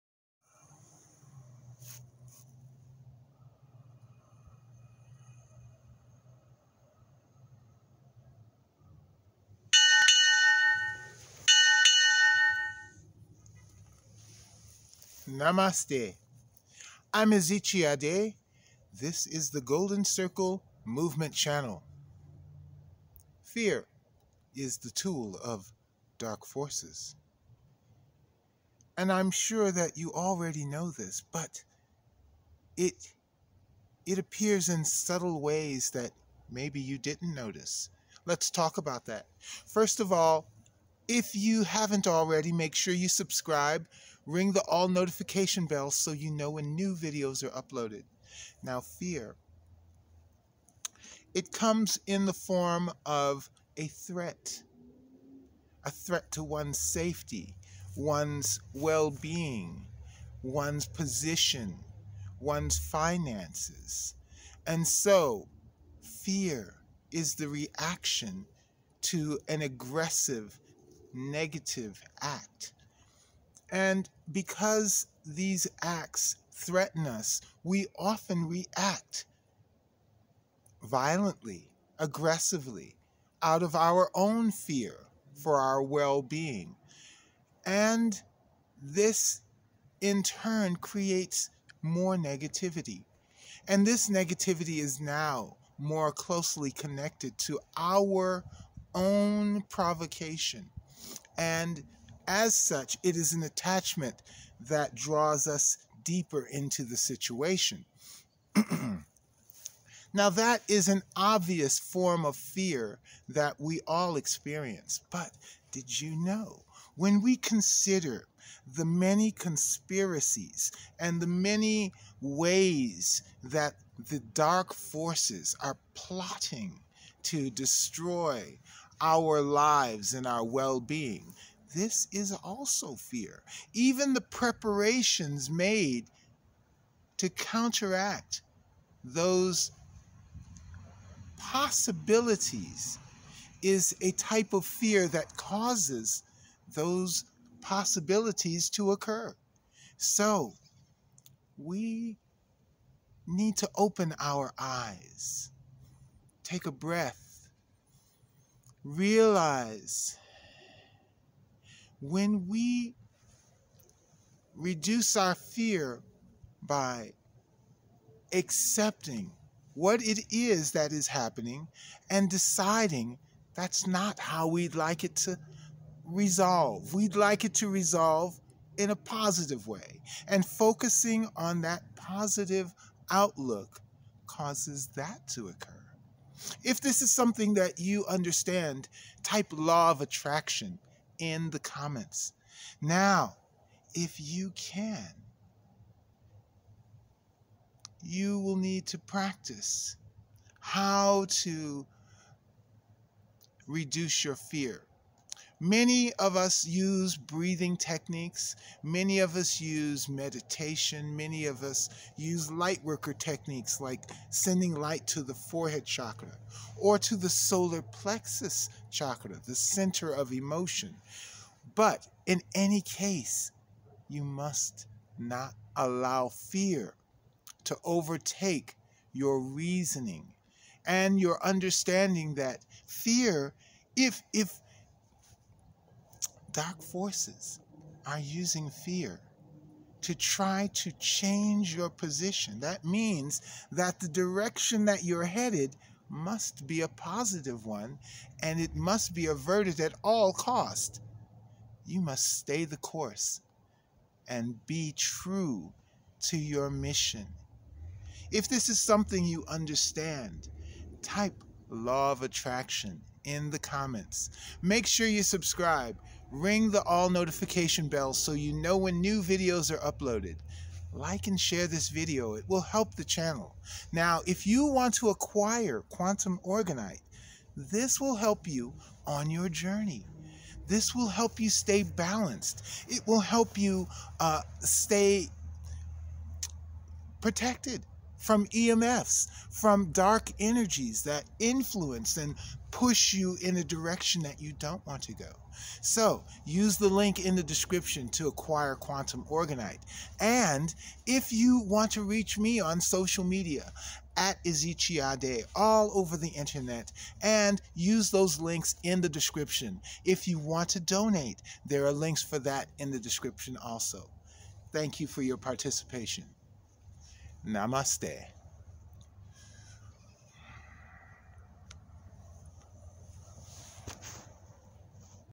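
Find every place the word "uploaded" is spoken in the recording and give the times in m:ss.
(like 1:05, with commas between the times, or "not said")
0:47, 4:29.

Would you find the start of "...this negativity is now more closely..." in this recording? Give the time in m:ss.
1:33.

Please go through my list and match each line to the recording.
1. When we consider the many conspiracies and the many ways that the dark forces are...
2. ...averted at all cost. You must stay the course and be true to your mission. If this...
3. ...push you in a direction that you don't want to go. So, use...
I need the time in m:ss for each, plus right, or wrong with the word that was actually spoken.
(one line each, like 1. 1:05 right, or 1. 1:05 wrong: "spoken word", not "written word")
1. 1:56 right
2. 4:09 right
3. 4:52 right.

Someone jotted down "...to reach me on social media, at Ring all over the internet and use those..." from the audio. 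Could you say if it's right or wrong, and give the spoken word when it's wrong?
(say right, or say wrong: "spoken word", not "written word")
wrong: "Ezichiade", not "Ring".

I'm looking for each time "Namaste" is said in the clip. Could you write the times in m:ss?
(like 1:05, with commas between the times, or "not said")
0:15, 5:17.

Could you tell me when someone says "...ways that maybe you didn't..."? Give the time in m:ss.
0:35.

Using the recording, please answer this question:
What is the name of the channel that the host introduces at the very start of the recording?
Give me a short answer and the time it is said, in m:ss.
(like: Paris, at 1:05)
Golden Circle Movement, at 0:19.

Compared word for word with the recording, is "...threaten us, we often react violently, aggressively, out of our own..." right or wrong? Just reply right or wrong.
right.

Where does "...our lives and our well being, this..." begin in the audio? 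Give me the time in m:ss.
2:08.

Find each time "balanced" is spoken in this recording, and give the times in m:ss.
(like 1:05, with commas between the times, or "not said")
4:41.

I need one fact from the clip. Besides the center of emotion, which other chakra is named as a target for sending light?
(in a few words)
Forehead chakra.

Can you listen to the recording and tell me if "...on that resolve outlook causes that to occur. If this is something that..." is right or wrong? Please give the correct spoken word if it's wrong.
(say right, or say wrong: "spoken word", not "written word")
wrong: "positive", not "resolve".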